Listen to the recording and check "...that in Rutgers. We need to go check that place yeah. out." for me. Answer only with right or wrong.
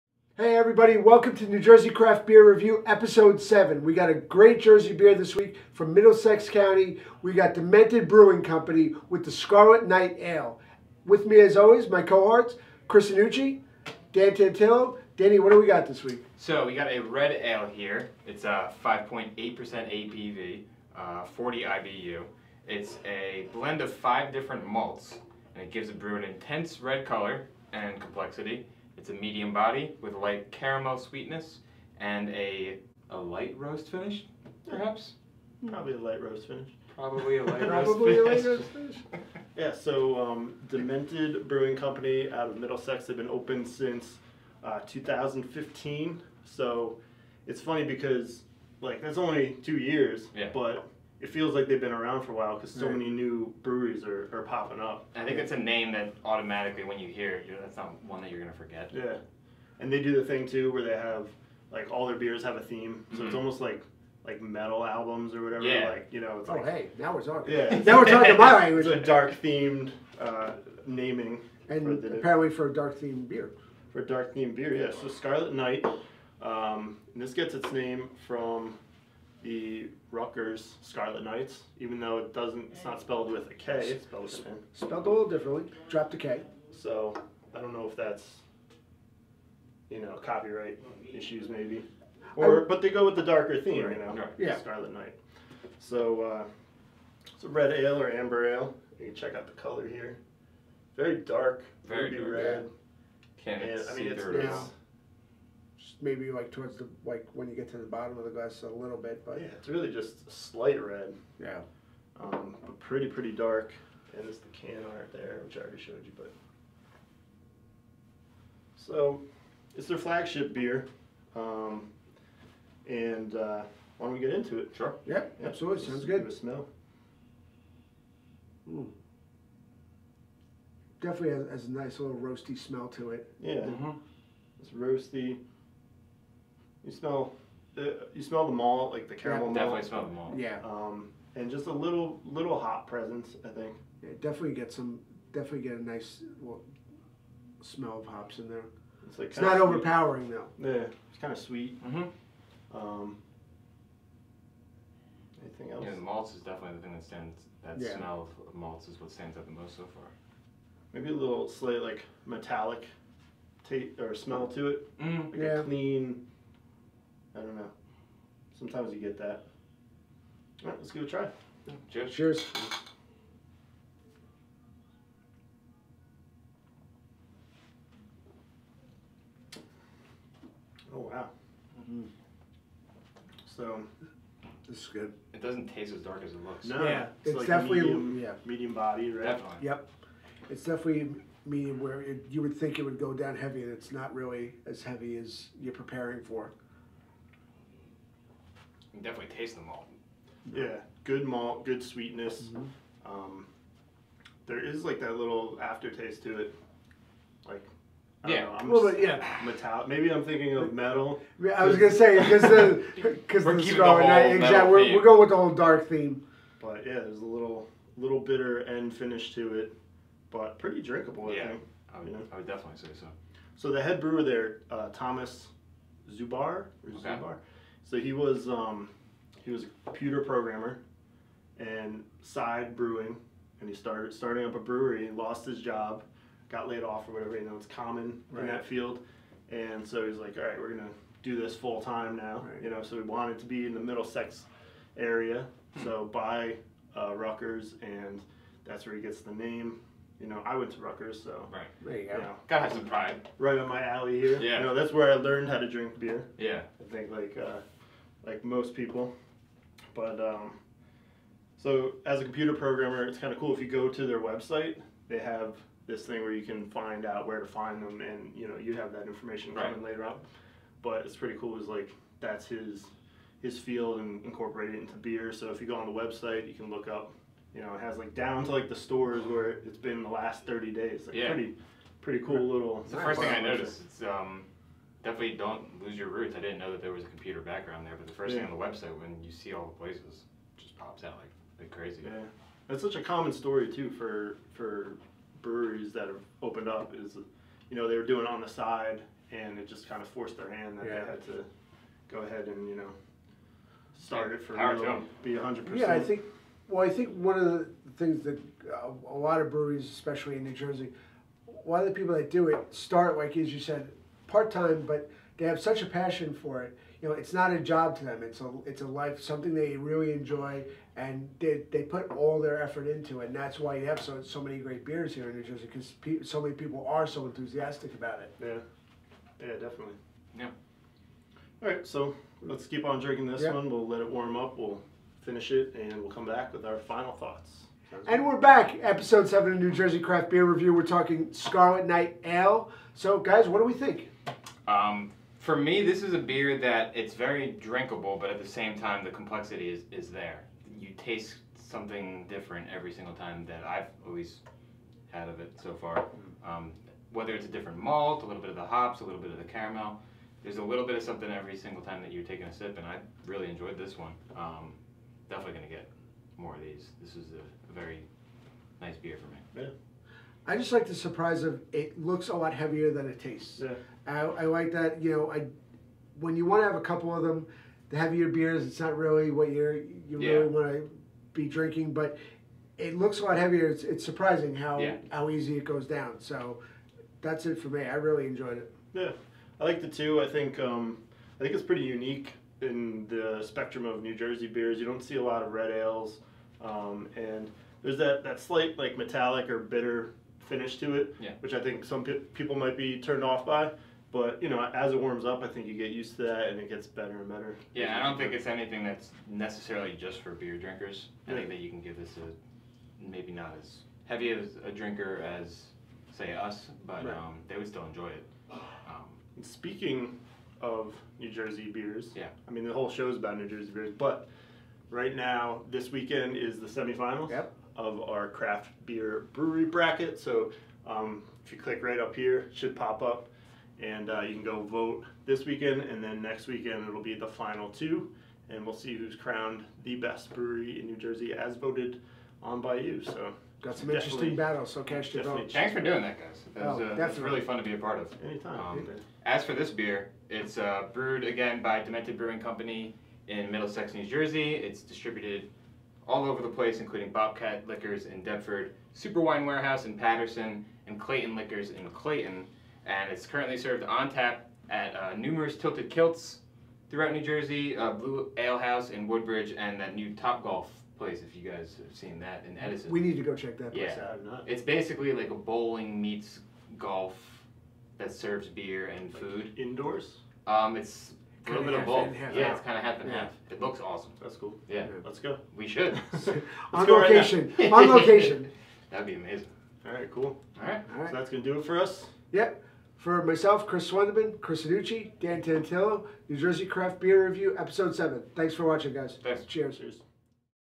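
wrong.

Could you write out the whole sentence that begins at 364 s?
Um, definitely going to get more of these.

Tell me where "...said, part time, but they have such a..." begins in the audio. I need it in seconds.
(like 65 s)
313 s.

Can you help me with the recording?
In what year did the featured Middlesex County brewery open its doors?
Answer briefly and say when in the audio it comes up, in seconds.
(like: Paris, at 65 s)
2015, at 44 s.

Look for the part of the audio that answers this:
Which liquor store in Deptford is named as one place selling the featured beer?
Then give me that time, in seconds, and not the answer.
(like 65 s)
457 s.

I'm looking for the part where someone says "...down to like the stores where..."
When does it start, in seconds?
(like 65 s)
278 s.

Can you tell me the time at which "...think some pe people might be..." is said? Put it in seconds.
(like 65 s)
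401 s.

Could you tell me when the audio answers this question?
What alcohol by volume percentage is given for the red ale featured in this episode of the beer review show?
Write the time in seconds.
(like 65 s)
18 s.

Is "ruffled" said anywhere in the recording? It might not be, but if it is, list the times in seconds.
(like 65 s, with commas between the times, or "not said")
not said.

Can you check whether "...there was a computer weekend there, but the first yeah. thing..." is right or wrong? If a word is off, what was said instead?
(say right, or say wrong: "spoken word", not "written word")
wrong: "background", not "weekend".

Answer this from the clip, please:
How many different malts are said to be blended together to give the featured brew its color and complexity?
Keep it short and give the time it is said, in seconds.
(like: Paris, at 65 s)
5, at 23 s.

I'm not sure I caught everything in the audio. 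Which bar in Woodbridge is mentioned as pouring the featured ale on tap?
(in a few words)
Blue Ale House.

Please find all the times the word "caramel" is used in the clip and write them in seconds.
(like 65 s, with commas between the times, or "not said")
30 s, 139 s, 359 s.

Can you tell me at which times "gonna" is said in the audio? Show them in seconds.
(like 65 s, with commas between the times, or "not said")
211 s, 240 s, 491 s.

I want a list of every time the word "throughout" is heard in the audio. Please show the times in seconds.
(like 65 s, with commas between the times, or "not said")
466 s.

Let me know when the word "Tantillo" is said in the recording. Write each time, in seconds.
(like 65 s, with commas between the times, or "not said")
14 s, 495 s.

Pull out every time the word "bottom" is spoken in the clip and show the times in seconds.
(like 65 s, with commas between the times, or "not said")
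107 s.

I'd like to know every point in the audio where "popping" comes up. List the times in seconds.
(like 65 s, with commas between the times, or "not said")
54 s.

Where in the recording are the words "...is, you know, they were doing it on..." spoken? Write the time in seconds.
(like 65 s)
296 s.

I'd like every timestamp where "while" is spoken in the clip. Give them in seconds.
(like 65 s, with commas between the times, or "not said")
52 s.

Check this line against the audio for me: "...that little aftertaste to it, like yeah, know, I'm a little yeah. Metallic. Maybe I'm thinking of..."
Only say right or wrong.
right.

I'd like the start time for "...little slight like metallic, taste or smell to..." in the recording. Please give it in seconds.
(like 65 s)
161 s.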